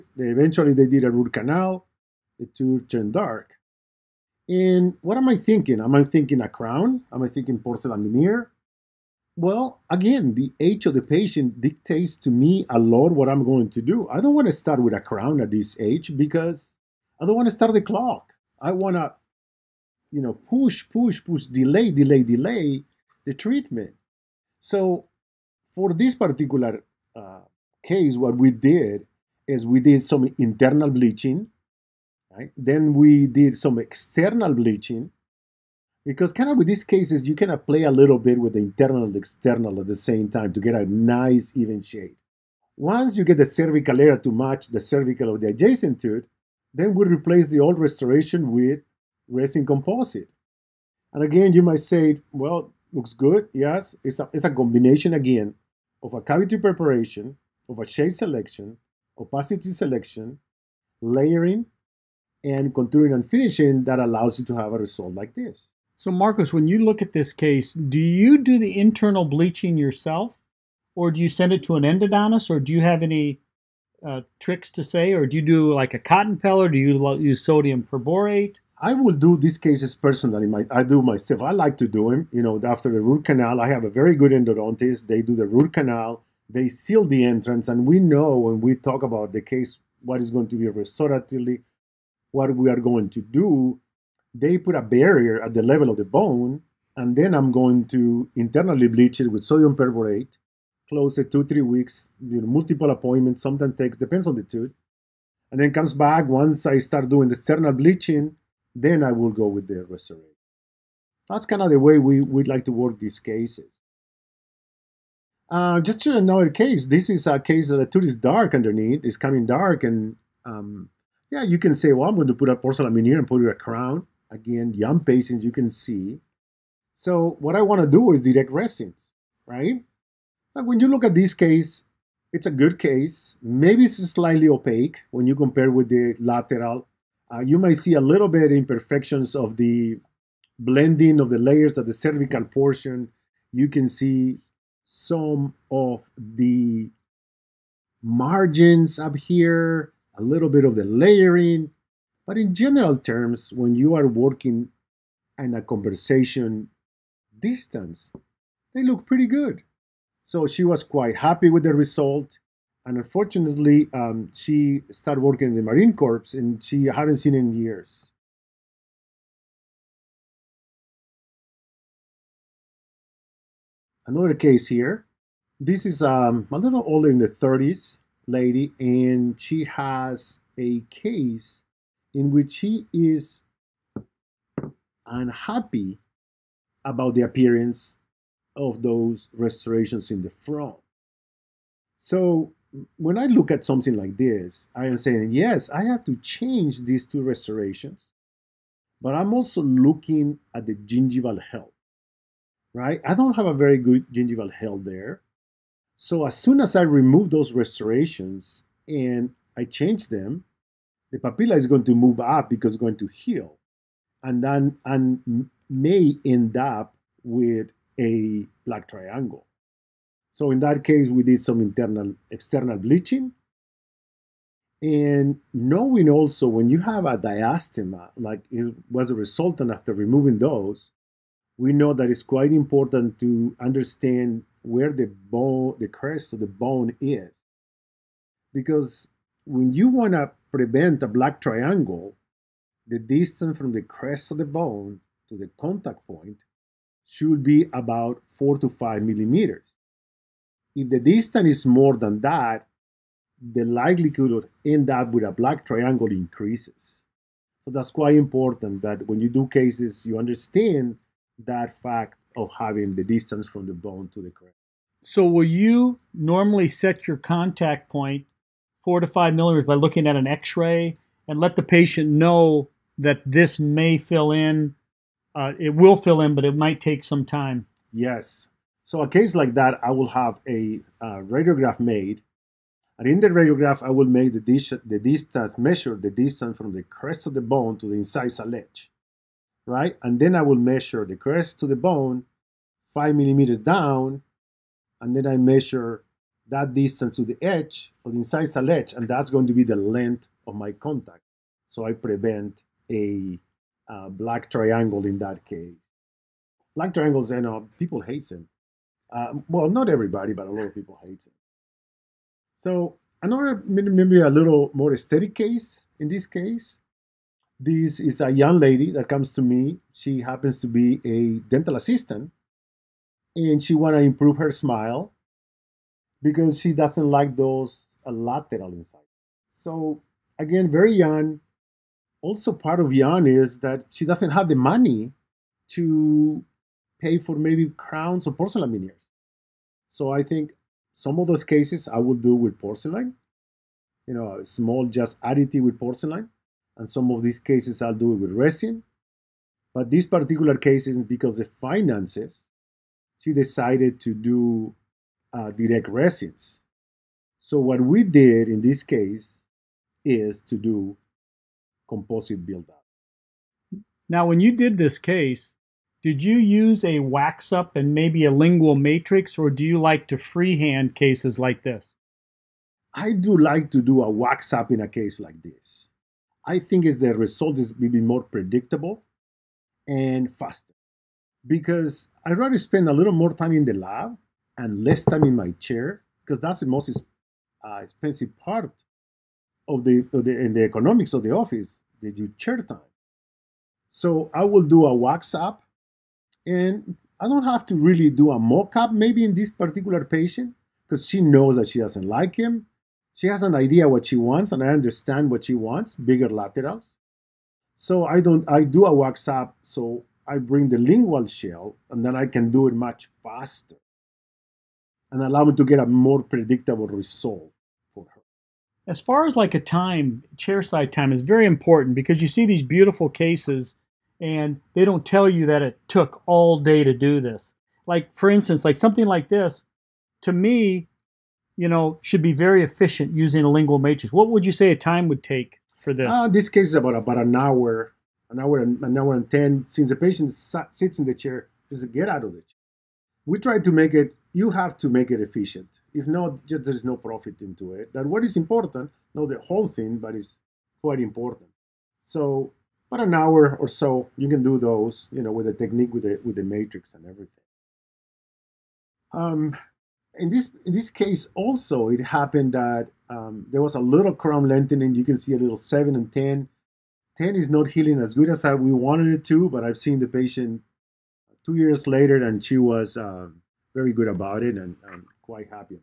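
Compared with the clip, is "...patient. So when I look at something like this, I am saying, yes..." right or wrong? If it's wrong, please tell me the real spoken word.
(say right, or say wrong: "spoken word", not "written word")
wrong: "front", not "patient".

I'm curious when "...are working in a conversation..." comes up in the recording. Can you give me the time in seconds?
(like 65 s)
153 s.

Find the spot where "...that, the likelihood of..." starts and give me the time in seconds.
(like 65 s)
252 s.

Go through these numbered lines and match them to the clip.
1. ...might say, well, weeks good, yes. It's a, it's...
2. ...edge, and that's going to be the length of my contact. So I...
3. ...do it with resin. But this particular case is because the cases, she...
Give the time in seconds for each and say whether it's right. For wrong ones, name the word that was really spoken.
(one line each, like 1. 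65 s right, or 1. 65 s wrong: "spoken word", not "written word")
1. 51 s wrong: "looks", not "weeks"
2. 298 s right
3. 347 s wrong: "finances", not "cases".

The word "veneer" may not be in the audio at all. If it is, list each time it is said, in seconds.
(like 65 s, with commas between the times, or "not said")
8 s, 122 s, 338 s.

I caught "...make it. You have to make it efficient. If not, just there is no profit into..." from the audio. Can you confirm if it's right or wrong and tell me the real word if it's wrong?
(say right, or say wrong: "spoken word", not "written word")
right.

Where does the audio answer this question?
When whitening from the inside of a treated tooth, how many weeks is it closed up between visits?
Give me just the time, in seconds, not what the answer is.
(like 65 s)
101 s.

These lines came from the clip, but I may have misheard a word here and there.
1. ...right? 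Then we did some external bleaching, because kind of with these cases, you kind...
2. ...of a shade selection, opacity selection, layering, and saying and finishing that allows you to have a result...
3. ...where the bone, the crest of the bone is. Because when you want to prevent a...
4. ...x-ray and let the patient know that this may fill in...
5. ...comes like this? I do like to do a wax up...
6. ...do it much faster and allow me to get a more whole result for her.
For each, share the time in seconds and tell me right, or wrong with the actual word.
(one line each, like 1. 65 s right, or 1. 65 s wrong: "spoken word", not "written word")
1. 32 s right
2. 57 s wrong: "contouring", not "saying"
3. 234 s right
4. 270 s right
5. 370 s wrong: "cases", not "comes"
6. 412 s wrong: "predictable", not "whole".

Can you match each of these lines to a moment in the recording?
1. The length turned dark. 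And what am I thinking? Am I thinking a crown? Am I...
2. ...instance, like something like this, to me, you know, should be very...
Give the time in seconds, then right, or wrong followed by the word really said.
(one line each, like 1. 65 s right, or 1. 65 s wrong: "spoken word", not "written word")
1. 2 s wrong: "tooth", not "length"
2. 428 s right.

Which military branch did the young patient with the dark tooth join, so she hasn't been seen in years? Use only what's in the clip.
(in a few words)
Marine Corps.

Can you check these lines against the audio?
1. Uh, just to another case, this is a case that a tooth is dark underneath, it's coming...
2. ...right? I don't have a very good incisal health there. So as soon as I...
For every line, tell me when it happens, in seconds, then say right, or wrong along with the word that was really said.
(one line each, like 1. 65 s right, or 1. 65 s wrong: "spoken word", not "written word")
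1. 115 s right
2. 202 s wrong: "gingival", not "incisal".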